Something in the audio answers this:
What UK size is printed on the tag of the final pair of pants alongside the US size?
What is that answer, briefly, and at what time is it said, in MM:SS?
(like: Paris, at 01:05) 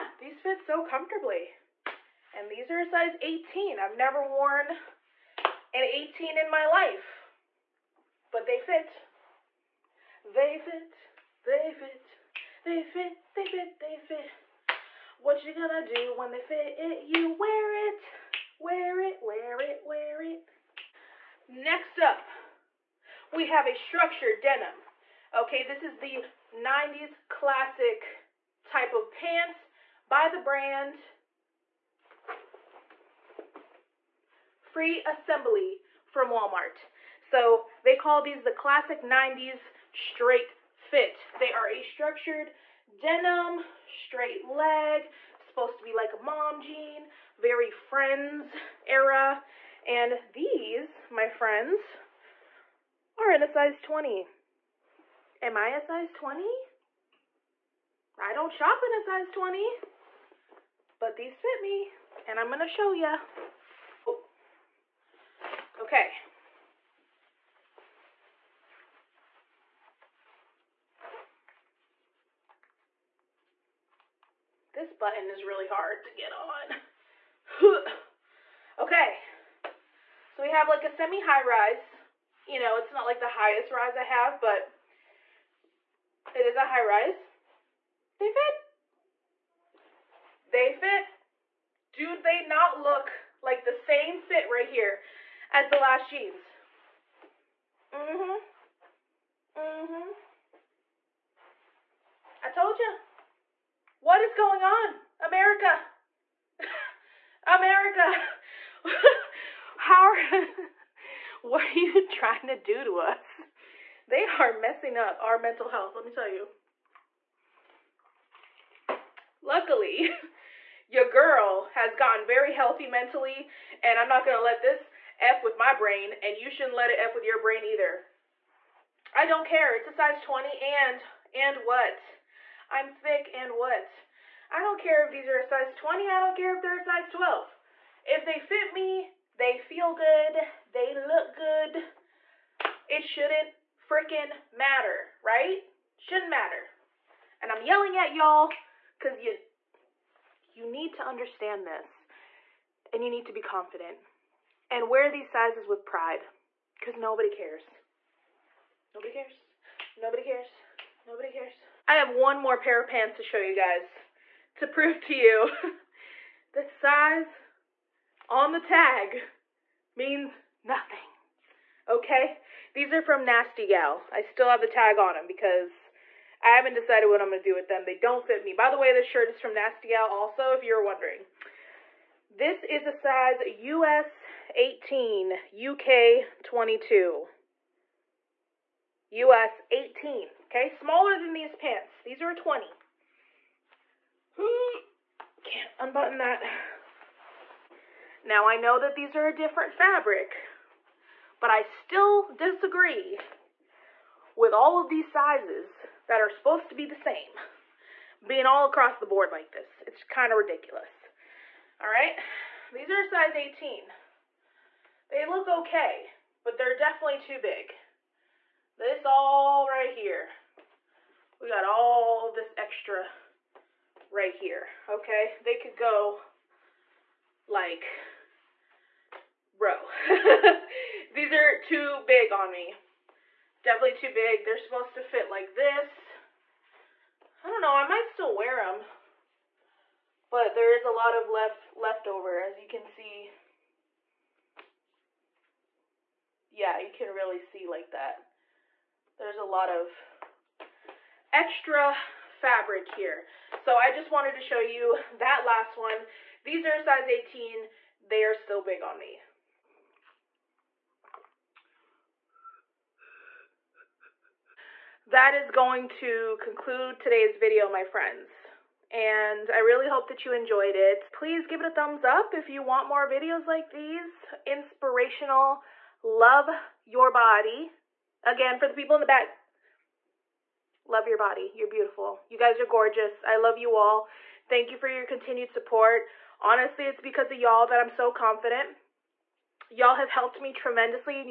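22, at 03:05.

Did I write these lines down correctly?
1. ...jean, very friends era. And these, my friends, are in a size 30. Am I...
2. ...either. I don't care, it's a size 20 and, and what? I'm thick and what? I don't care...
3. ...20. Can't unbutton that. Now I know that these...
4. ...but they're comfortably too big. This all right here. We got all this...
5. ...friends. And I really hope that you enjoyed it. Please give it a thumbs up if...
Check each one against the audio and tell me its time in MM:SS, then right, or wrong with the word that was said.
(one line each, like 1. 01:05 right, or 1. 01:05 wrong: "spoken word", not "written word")
1. 00:46 wrong: "20", not "30"
2. 02:07 right
3. 03:12 right
4. 03:36 wrong: "definitely", not "comfortably"
5. 04:27 right.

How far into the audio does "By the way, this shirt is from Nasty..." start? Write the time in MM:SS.
02:58.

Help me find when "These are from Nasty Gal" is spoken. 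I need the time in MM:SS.
02:52.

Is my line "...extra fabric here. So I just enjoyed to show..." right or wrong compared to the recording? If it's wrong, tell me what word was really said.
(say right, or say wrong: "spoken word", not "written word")
wrong: "wanted", not "enjoyed".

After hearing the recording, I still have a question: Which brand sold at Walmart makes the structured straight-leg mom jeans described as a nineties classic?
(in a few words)
Free Assembly.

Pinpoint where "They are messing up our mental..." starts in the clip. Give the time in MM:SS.
01:54.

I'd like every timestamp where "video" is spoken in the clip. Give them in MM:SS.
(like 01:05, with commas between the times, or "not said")
04:27, 04:33.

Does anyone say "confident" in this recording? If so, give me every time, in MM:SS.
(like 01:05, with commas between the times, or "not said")
02:33, 04:48.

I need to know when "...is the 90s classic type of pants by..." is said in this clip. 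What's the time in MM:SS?
00:25.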